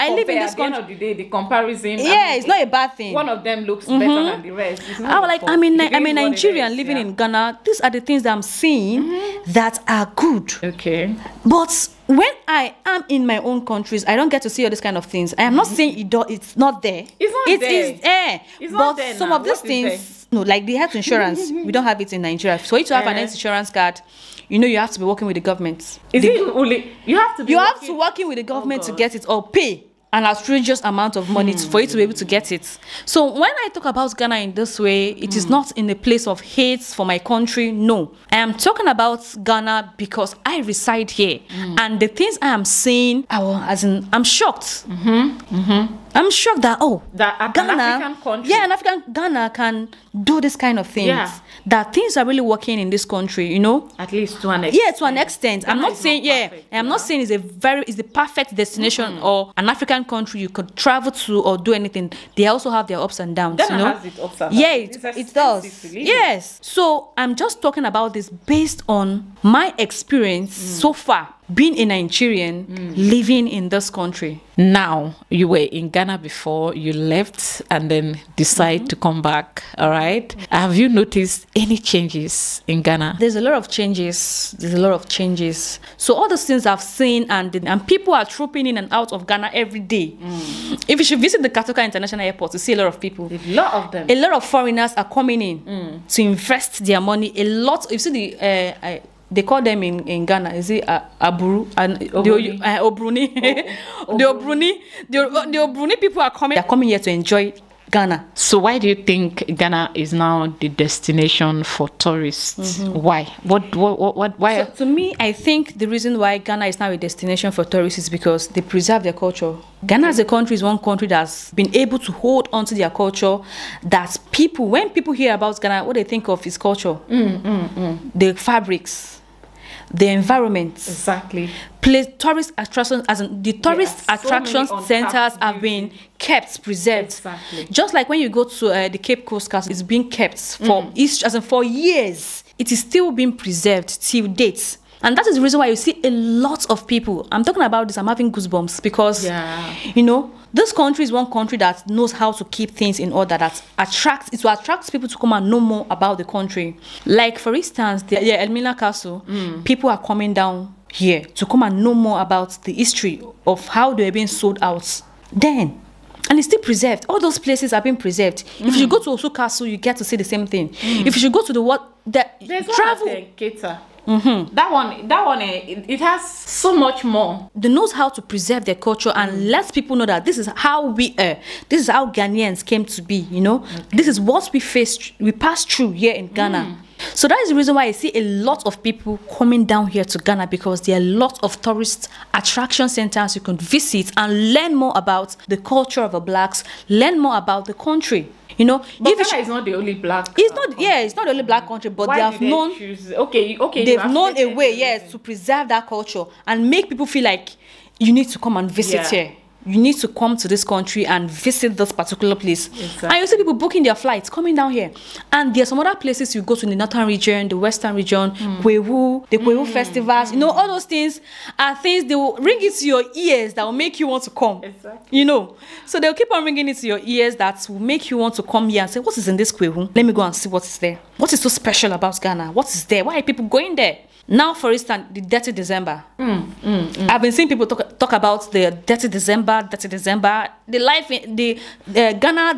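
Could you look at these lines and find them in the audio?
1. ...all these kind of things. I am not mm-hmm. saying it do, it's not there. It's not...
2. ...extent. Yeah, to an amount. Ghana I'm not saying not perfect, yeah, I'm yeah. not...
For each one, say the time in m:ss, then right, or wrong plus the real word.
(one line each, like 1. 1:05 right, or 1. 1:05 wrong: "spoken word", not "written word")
1. 0:14 right
2. 0:54 wrong: "extent", not "amount".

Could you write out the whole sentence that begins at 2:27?
I'm talking about this, I'm having goosebumps because, yeah.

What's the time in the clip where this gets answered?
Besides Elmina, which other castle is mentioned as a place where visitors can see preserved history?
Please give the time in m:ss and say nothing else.
2:49.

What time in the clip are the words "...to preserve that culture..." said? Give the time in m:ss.
3:25.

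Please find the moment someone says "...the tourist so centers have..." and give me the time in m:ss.
2:13.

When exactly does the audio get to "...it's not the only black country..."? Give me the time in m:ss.
3:20.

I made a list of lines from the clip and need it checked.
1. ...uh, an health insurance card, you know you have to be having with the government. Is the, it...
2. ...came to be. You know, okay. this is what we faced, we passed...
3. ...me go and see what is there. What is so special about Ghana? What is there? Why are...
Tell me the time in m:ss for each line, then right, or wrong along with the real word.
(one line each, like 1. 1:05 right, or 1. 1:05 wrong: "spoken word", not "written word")
1. 0:23 wrong: "working", not "having"
2. 3:02 right
3. 3:50 right.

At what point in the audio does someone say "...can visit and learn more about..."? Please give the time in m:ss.
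3:13.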